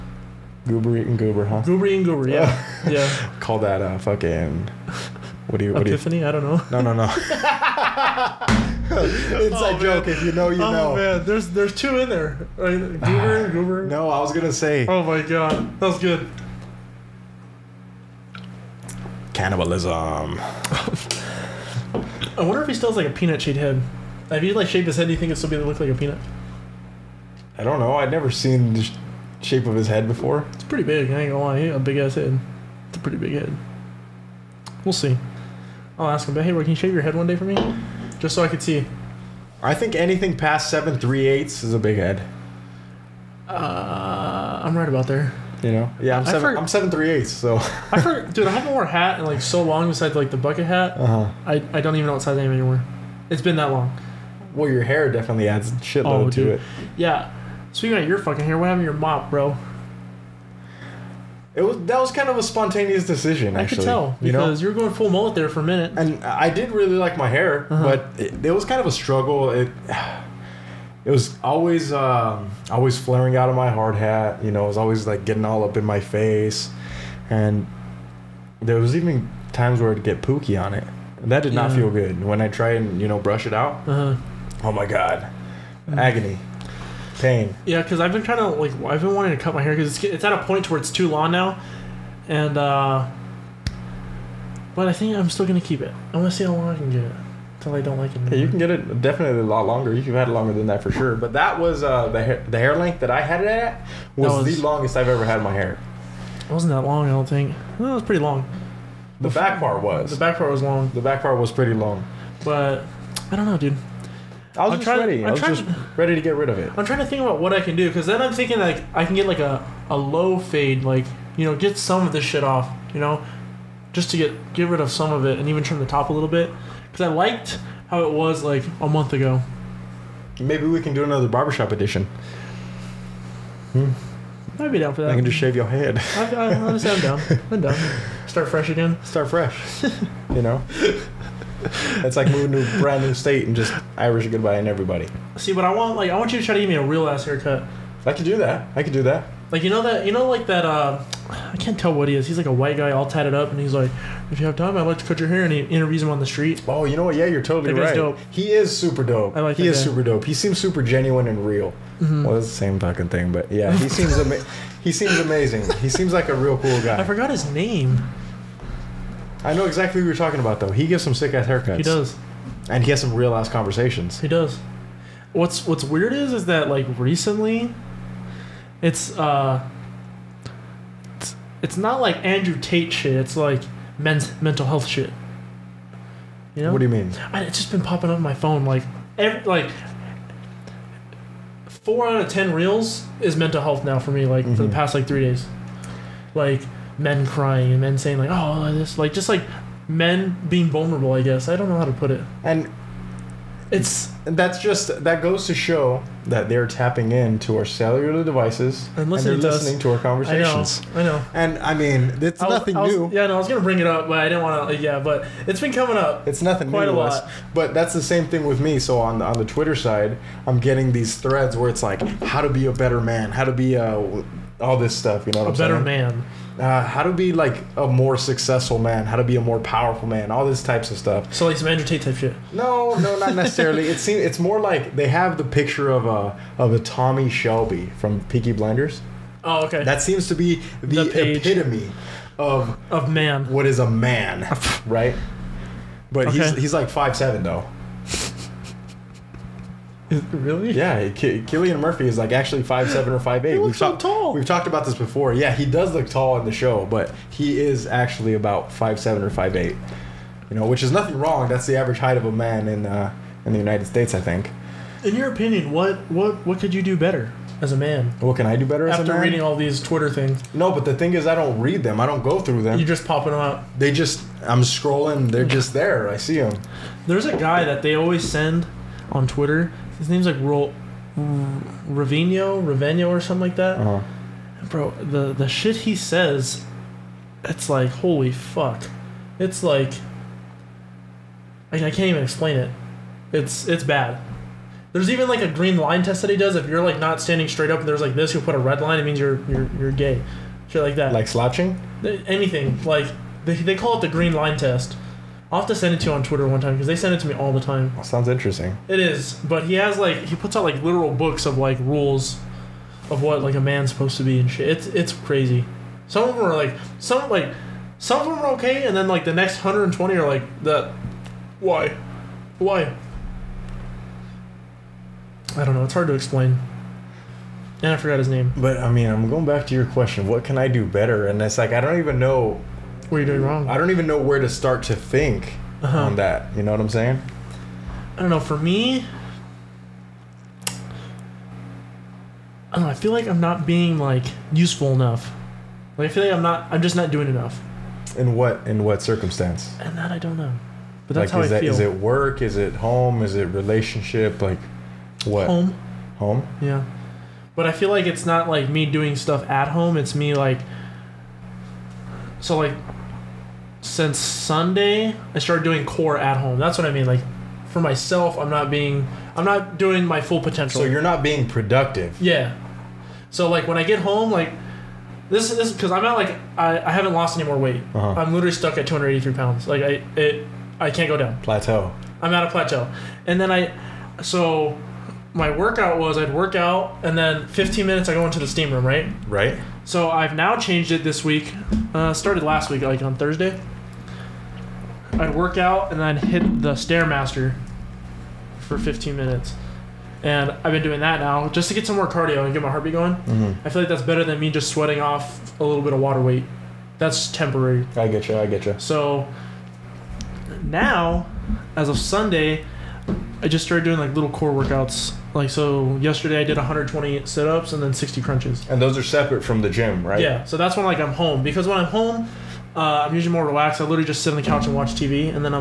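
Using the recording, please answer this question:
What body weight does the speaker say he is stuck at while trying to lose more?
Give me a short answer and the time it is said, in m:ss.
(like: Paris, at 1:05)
283 pounds, at 6:18.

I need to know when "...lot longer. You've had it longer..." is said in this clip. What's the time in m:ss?
1:39.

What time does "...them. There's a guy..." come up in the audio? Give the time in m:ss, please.
4:36.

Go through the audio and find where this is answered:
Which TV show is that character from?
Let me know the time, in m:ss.
3:58.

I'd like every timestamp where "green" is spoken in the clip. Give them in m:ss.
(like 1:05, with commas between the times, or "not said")
4:55, 5:04.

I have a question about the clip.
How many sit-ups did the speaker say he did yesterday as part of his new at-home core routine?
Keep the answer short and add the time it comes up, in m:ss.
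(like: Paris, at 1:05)
120, at 6:56.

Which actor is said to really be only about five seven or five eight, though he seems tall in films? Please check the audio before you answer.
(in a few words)
Cillian Murphy.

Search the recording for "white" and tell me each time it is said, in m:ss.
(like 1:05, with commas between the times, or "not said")
2:32.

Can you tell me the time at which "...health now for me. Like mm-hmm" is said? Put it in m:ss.
3:13.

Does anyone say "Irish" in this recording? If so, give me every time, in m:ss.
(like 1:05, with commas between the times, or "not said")
2:23.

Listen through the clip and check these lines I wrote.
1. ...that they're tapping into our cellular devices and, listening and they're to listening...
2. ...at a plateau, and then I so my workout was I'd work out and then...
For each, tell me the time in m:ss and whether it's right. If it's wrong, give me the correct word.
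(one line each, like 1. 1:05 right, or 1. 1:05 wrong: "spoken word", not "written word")
1. 3:26 right
2. 6:22 right.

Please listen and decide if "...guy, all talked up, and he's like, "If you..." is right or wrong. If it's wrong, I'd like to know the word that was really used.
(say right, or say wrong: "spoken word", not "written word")
wrong: "tatted", not "talked".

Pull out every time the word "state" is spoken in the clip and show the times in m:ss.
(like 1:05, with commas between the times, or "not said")
2:23, 4:23.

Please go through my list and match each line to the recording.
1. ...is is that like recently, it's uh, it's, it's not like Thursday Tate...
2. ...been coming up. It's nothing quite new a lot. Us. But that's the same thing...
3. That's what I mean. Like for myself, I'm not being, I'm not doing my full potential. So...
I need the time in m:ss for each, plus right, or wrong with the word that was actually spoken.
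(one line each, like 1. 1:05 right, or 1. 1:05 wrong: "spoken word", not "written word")
1. 2:56 wrong: "Andrew", not "Thursday"
2. 3:35 right
3. 6:06 right.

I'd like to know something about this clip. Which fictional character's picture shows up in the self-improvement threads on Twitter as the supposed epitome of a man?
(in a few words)
Tommy Shelby.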